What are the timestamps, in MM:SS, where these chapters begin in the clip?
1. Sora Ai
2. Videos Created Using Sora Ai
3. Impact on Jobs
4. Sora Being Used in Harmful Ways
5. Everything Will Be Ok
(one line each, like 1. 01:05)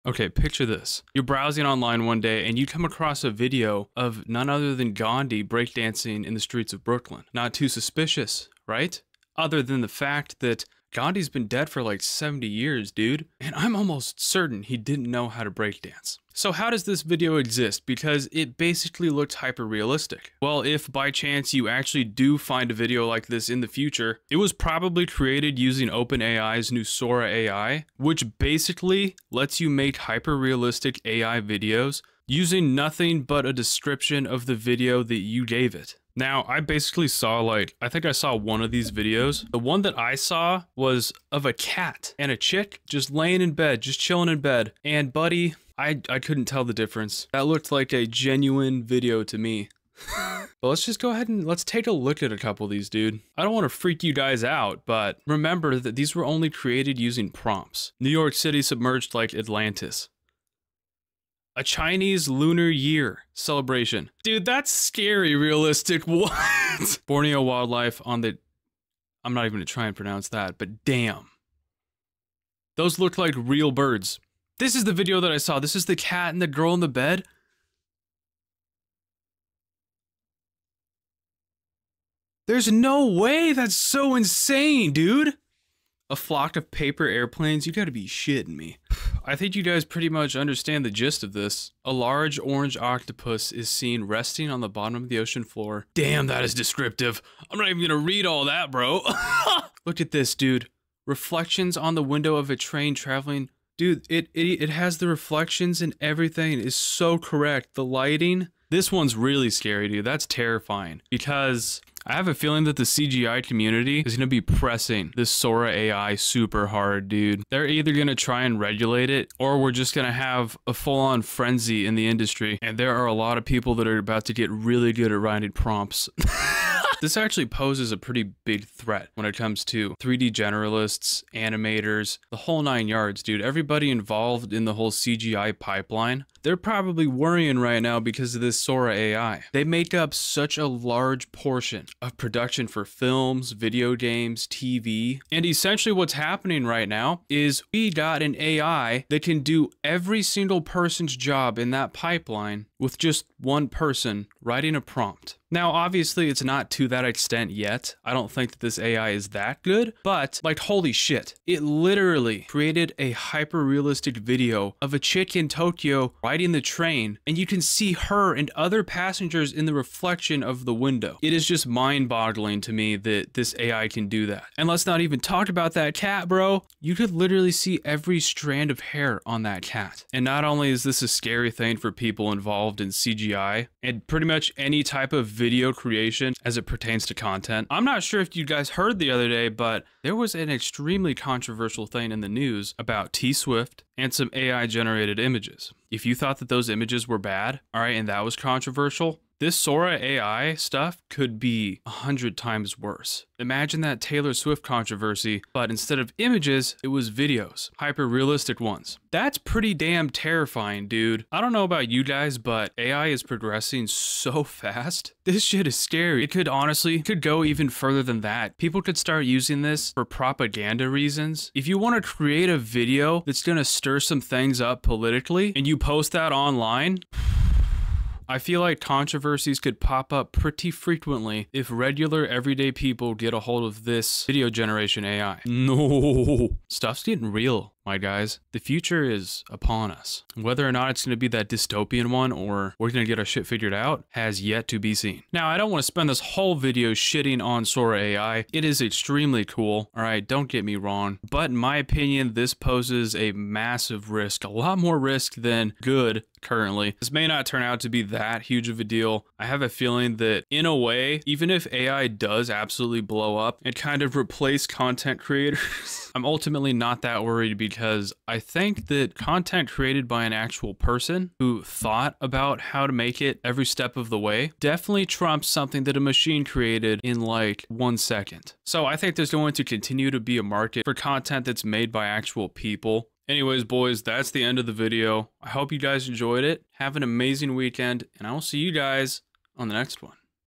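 1. 00:25
2. 00:57
3. 01:51
4. 03:07
5. 04:19.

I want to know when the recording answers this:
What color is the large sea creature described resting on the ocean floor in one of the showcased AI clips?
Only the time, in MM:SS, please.
01:32.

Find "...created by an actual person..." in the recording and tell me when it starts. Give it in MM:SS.
04:29.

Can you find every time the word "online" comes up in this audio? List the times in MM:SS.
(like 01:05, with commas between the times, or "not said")
00:01, 03:46.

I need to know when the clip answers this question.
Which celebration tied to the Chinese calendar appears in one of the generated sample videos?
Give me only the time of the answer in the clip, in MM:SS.
01:01.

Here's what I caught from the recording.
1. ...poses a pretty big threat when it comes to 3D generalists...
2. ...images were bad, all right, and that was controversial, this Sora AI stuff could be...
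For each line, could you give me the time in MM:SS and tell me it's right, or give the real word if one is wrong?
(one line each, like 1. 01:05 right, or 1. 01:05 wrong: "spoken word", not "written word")
1. 02:07 right
2. 03:16 right.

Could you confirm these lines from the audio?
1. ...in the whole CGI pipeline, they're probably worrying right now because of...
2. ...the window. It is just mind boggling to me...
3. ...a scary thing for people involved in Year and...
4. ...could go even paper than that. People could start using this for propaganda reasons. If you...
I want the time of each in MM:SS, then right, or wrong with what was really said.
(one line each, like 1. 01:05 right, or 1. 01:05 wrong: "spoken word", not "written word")
1. 02:14 right
2. 02:50 right
3. 03:01 wrong: "CGI", not "Year"
4. 03:37 wrong: "further", not "paper".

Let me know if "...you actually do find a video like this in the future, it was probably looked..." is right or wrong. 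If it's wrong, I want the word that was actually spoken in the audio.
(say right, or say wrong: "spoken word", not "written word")
wrong: "created", not "looked".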